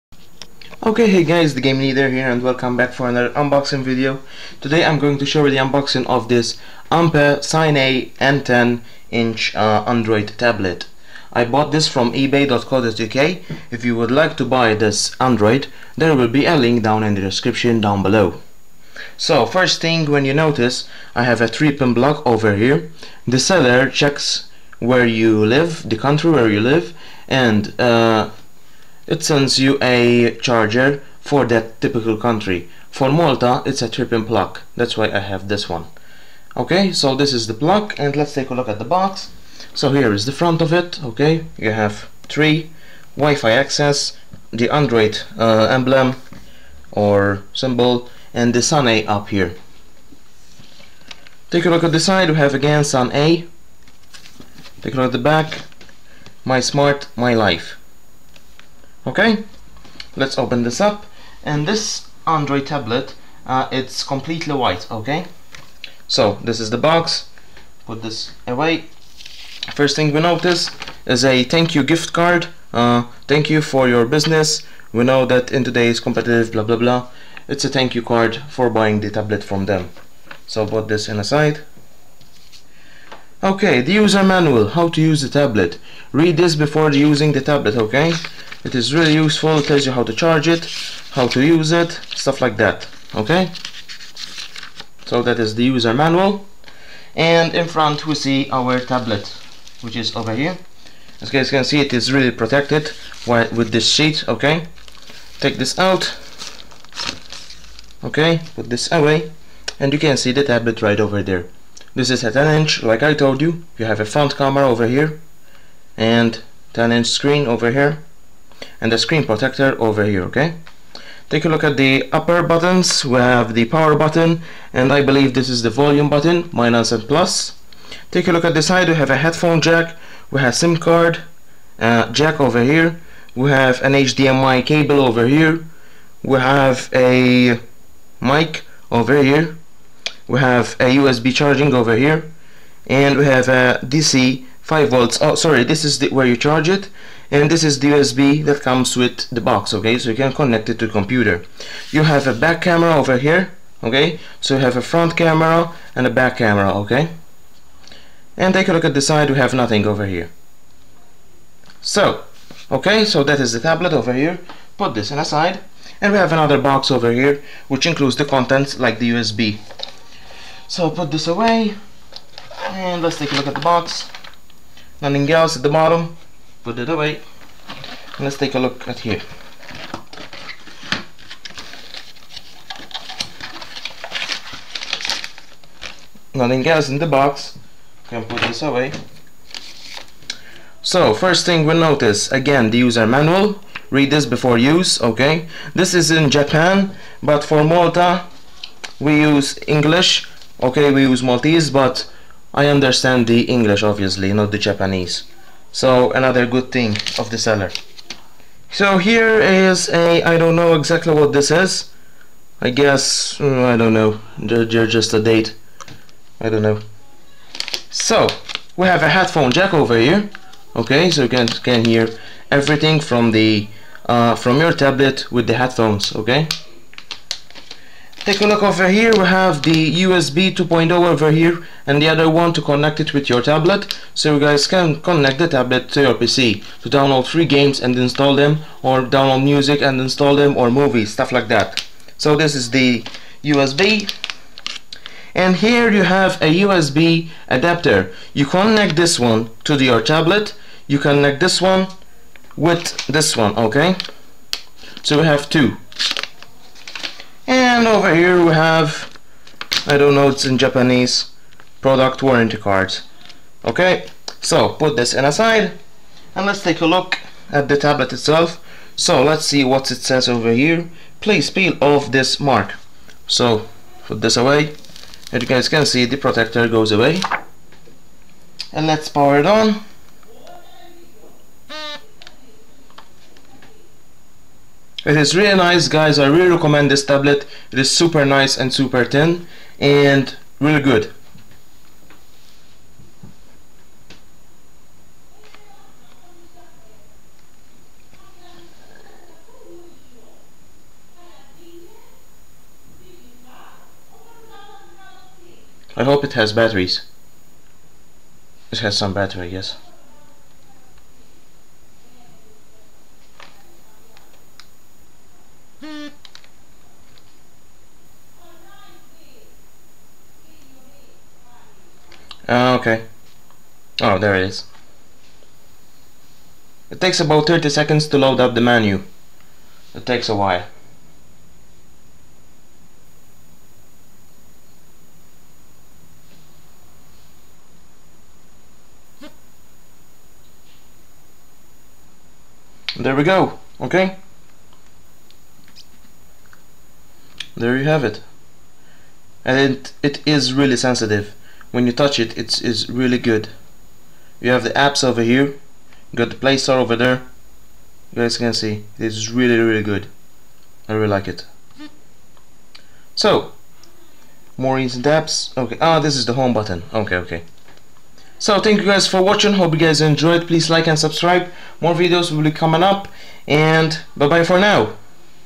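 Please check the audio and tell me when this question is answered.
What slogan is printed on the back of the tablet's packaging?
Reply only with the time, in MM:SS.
00:56.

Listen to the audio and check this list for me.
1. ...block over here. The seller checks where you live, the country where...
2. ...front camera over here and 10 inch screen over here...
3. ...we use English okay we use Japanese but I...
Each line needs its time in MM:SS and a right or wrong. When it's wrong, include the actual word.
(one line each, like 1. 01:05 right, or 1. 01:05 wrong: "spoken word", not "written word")
1. 00:21 right
2. 01:54 right
3. 03:18 wrong: "Maltese", not "Japanese".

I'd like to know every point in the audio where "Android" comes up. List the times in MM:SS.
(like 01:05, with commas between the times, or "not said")
00:09, 00:15, 00:44, 01:02.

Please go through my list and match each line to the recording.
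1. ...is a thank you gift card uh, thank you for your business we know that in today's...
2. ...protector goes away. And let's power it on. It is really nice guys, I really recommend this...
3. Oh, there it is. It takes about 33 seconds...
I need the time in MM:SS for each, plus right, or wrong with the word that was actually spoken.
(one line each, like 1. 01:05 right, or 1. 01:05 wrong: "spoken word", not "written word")
1. 01:11 right
2. 04:36 right
3. 05:24 wrong: "30", not "33".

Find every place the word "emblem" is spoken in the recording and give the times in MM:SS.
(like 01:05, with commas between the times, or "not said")
00:45.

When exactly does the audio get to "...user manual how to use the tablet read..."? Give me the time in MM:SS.
01:23.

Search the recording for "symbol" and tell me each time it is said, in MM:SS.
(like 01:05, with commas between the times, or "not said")
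00:47.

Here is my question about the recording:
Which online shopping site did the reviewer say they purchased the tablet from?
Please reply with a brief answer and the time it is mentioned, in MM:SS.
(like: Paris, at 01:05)
ebay.co.uk, at 00:12.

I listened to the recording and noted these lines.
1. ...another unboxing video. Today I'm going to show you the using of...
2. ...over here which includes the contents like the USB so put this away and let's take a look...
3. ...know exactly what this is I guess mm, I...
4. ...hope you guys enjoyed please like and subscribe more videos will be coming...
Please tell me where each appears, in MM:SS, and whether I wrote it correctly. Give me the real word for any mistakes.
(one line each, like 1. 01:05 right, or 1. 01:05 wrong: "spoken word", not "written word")
1. 00:03 wrong: "unboxing", not "using"
2. 02:46 right
3. 03:30 right
4. 06:09 right.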